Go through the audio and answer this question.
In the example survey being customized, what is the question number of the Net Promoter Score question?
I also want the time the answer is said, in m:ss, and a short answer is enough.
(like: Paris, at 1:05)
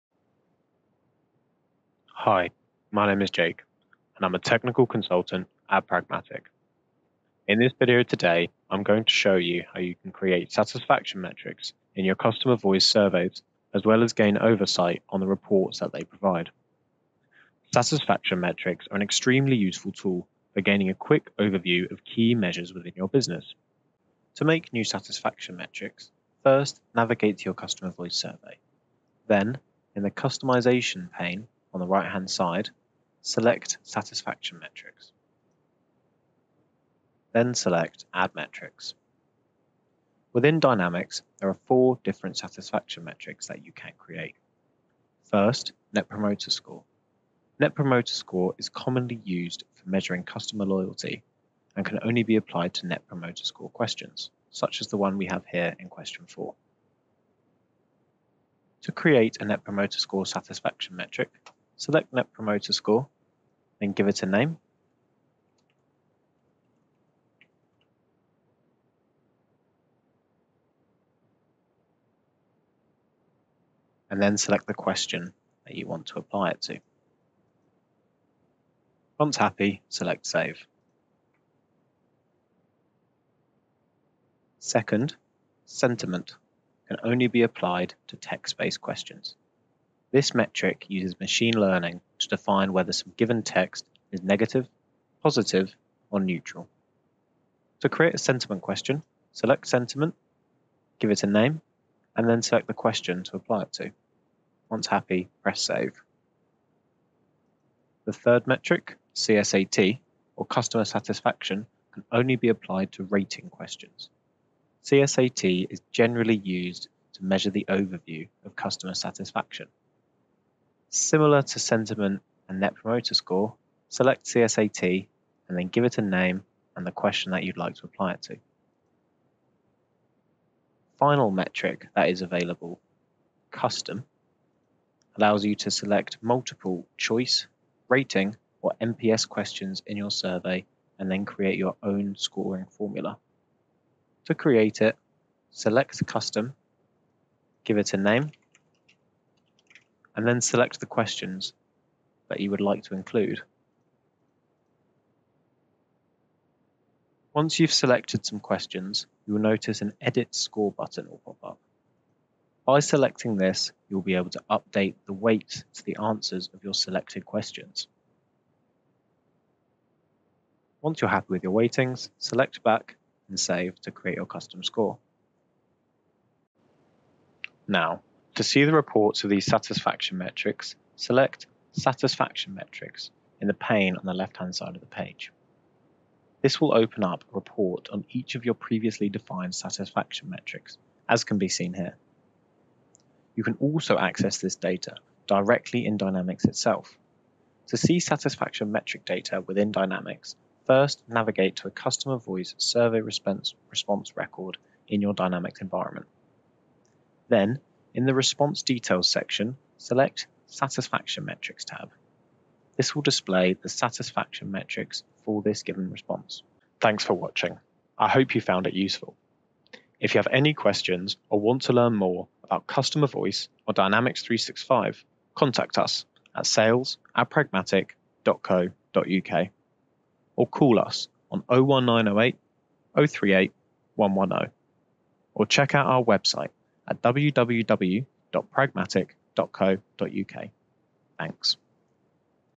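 4, at 0:55.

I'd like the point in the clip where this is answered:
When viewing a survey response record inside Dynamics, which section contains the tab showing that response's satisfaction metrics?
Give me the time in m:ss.
3:28.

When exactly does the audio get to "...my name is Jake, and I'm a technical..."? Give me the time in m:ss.
0:02.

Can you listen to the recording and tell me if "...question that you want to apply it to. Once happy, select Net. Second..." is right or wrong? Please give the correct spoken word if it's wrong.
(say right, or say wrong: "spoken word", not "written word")
wrong: "Save", not "Net".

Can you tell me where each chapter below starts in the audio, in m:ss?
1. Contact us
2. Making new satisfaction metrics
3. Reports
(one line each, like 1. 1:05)
1. 3:37
2. 0:26
3. 2:59.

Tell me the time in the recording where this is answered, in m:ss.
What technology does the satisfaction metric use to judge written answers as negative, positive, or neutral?
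1:31.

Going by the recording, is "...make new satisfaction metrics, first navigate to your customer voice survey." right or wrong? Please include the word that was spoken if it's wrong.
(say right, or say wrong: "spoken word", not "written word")
right.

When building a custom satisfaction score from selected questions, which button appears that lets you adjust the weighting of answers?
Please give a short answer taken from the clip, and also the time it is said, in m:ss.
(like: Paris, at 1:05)
Edit Score, at 2:40.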